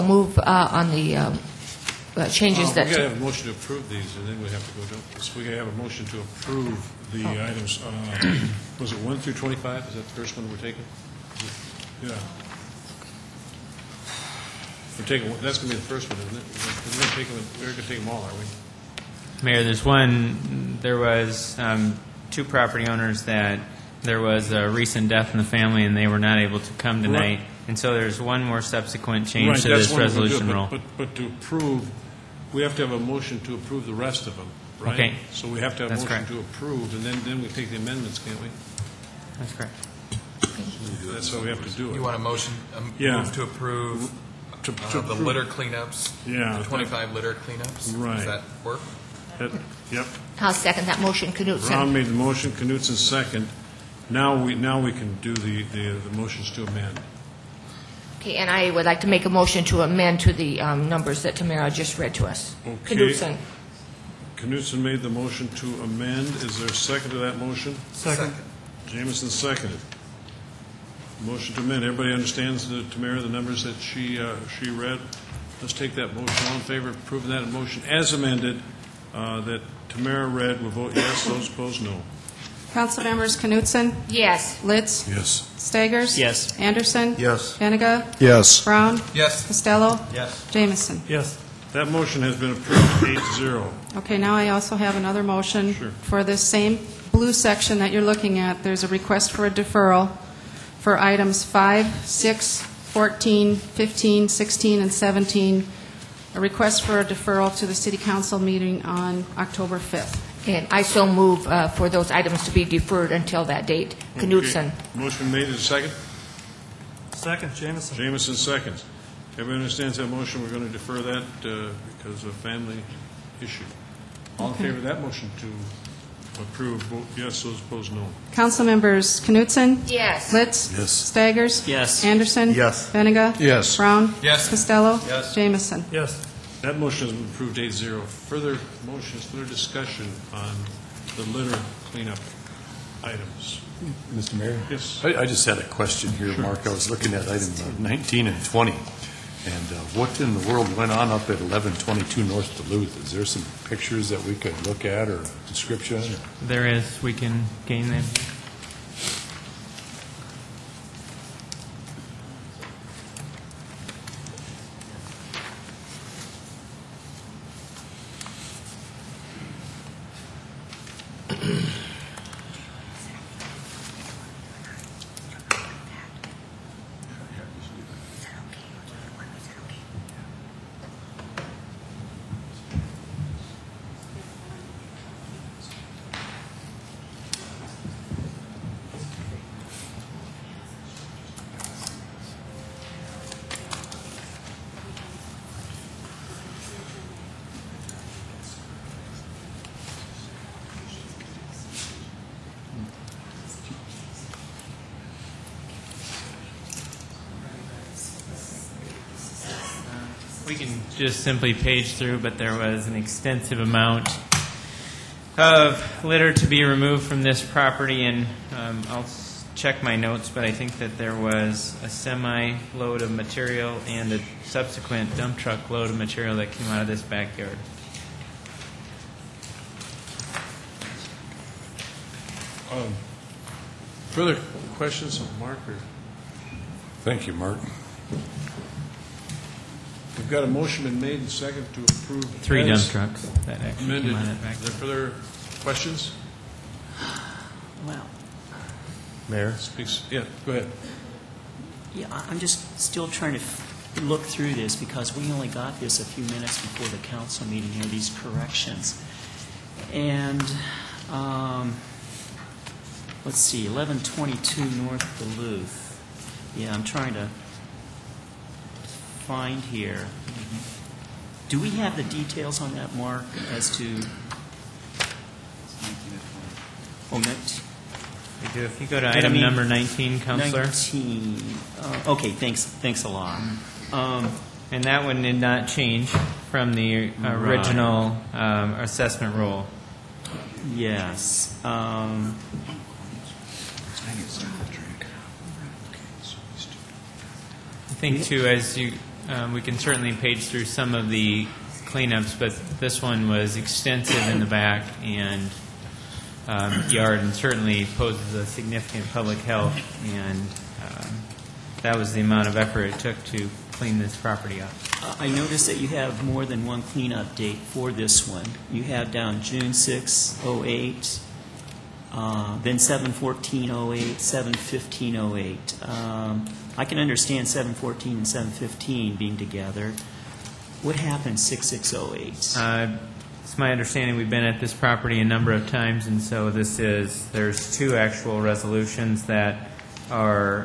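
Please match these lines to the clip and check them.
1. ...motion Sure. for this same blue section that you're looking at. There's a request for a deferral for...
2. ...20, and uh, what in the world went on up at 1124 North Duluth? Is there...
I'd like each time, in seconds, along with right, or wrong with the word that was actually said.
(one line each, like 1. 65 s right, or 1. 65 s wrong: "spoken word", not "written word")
1. 95 s right
2. 148 s wrong: "1122", not "1124".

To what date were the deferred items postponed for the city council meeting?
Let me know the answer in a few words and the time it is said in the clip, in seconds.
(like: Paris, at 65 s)
October 5th, at 109 s.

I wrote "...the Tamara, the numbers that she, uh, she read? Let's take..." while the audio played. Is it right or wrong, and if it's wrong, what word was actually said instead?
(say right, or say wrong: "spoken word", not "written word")
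right.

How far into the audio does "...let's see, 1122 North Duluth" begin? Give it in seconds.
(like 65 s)
263 s.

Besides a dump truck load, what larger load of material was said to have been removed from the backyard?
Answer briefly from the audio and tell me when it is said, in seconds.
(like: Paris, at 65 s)
a semi load, at 221 s.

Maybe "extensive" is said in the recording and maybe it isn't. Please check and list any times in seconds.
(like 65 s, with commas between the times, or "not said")
212 s, 303 s.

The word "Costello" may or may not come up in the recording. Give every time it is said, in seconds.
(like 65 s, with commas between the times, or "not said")
89 s, 134 s.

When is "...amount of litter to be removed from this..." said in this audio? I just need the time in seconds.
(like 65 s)
213 s.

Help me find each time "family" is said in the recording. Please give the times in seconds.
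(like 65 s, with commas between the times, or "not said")
25 s, 122 s.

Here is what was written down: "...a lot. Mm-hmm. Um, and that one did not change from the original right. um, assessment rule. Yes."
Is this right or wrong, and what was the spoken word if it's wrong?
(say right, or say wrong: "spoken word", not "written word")
right.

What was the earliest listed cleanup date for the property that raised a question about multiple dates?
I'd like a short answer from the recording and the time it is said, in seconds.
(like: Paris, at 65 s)
June 6, 2008, at 319 s.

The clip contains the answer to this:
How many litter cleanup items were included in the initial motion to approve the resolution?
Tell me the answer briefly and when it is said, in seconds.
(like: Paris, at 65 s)
25, at 46 s.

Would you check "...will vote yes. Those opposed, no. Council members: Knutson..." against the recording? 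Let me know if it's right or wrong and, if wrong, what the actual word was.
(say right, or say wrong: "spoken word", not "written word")
right.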